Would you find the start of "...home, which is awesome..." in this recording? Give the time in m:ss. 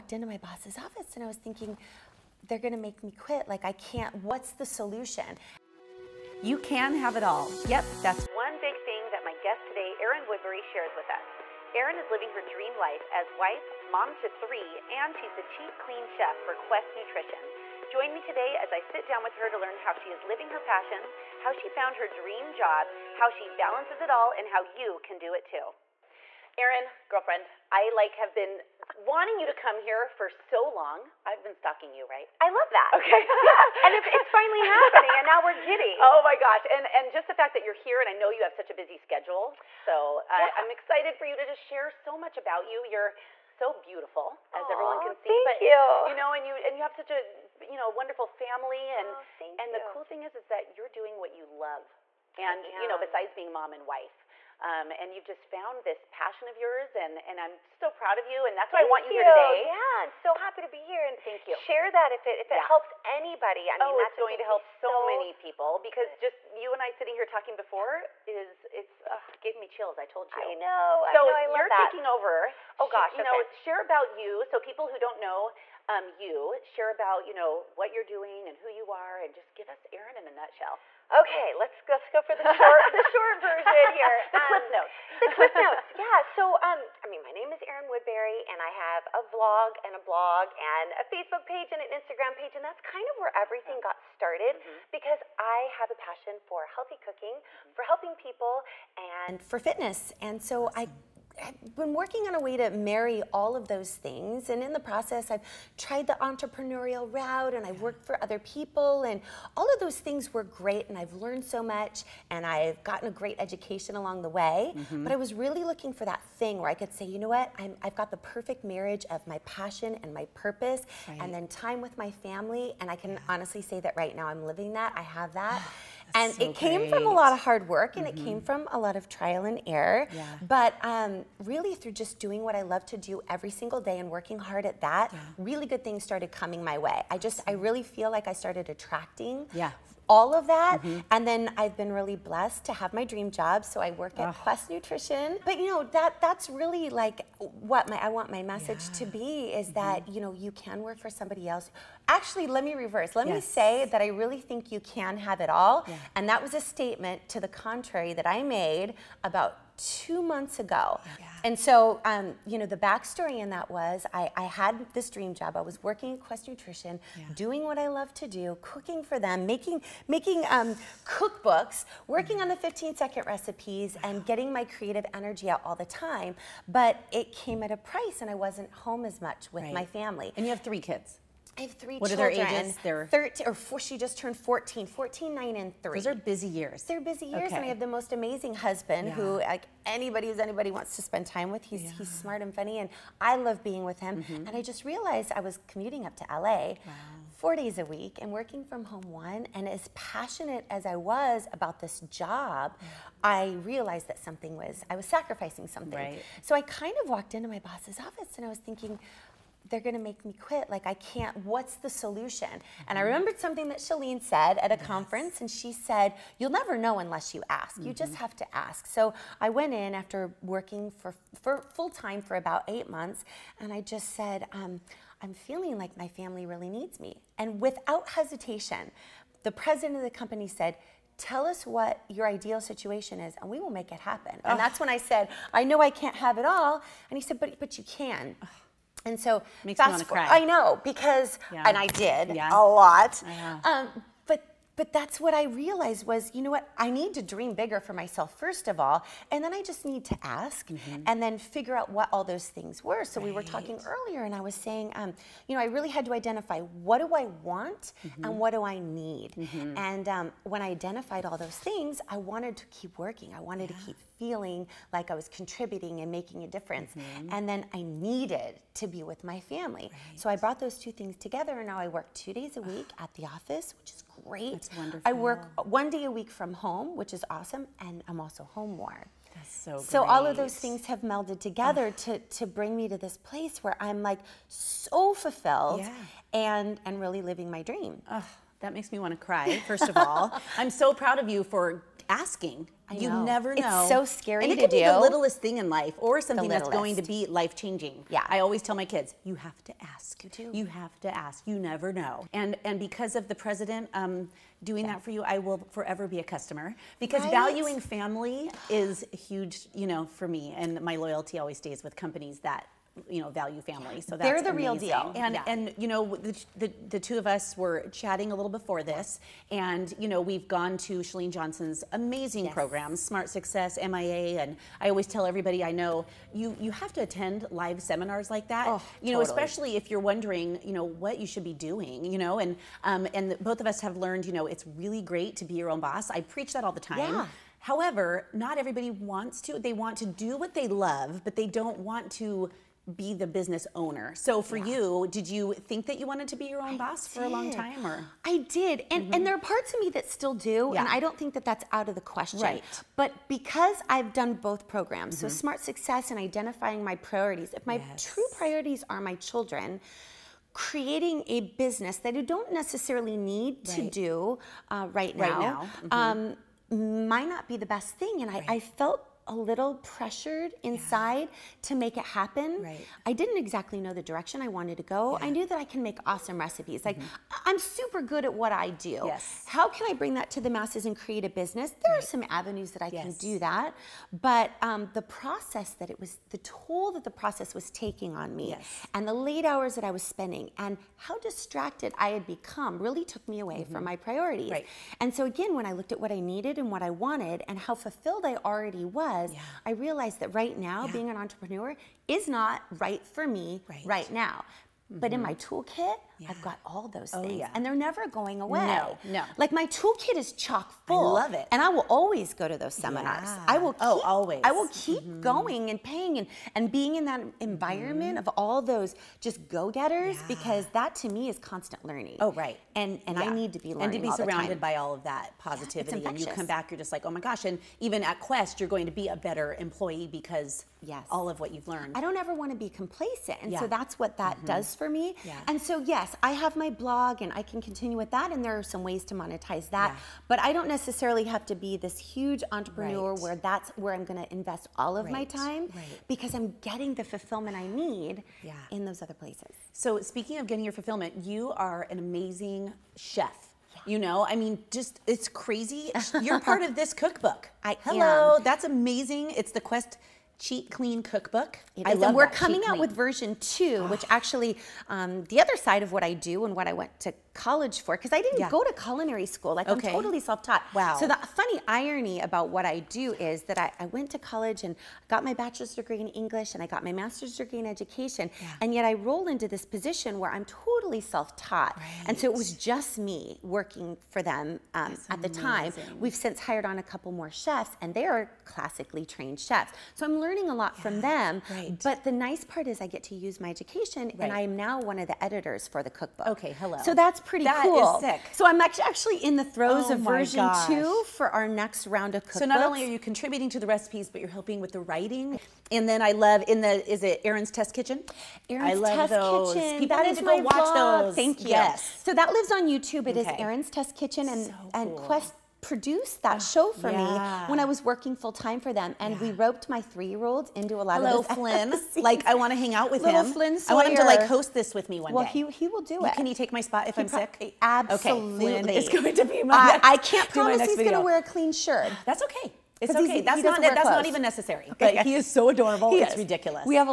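4:36.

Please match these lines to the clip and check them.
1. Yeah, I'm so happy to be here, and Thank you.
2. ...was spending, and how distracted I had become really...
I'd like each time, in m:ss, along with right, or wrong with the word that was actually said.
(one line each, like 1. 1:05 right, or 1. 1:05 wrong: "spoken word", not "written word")
1. 0:59 right
2. 6:29 right.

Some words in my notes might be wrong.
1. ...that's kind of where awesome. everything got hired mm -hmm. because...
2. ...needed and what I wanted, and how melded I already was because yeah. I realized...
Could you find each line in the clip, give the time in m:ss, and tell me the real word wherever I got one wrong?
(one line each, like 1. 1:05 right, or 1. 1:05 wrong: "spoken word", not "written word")
1. 1:32 wrong: "started", not "hired"
2. 6:36 wrong: "fulfilled", not "melded".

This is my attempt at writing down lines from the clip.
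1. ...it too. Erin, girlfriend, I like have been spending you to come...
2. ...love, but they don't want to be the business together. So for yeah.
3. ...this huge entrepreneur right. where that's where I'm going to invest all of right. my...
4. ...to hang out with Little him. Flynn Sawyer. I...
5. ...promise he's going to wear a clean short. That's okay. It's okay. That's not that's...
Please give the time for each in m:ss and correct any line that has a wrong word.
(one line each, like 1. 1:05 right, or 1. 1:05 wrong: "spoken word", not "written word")
1. 0:25 wrong: "wanting", not "spending"
2. 5:40 wrong: "owner", not "together"
3. 7:21 right
4. 8:42 right
5. 8:50 wrong: "shirt", not "short".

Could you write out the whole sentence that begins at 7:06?
and you come back, you're just like, oh my gosh.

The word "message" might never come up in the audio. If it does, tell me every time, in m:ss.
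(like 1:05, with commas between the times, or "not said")
2:28.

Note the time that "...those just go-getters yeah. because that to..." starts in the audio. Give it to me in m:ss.
6:58.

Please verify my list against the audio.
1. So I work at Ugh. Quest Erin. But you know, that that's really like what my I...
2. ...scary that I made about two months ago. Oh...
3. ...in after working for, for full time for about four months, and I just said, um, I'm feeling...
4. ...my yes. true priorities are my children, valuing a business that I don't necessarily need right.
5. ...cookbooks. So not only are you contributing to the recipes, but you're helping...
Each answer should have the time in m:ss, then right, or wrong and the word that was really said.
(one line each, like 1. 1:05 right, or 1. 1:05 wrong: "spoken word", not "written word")
1. 2:23 wrong: "Nutrition", not "Erin"
2. 2:37 wrong: "contrary", not "scary"
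3. 3:39 wrong: "eight", not "four"
4. 5:57 wrong: "creating", not "valuing"
5. 8:22 right.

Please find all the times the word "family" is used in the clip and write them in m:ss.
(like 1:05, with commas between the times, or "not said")
0:48, 2:02, 2:59, 3:46, 4:29, 5:07, 5:13.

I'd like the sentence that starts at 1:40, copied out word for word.
I I've been working on a way to marry all of those things.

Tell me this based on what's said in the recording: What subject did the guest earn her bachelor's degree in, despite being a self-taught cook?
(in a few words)
English.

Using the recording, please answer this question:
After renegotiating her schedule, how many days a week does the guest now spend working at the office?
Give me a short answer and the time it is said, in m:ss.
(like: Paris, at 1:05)
2, at 4:32.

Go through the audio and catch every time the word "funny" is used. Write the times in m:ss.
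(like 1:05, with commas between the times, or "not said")
3:12, 7:51.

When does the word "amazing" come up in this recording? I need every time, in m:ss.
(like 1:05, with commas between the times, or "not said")
3:08, 5:14, 5:21, 7:31, 7:38.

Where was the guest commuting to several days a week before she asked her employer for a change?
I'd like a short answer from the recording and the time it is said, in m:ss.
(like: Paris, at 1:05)
LA, at 3:16.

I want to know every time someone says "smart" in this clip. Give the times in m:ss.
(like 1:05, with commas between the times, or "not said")
3:12, 5:23, 5:55.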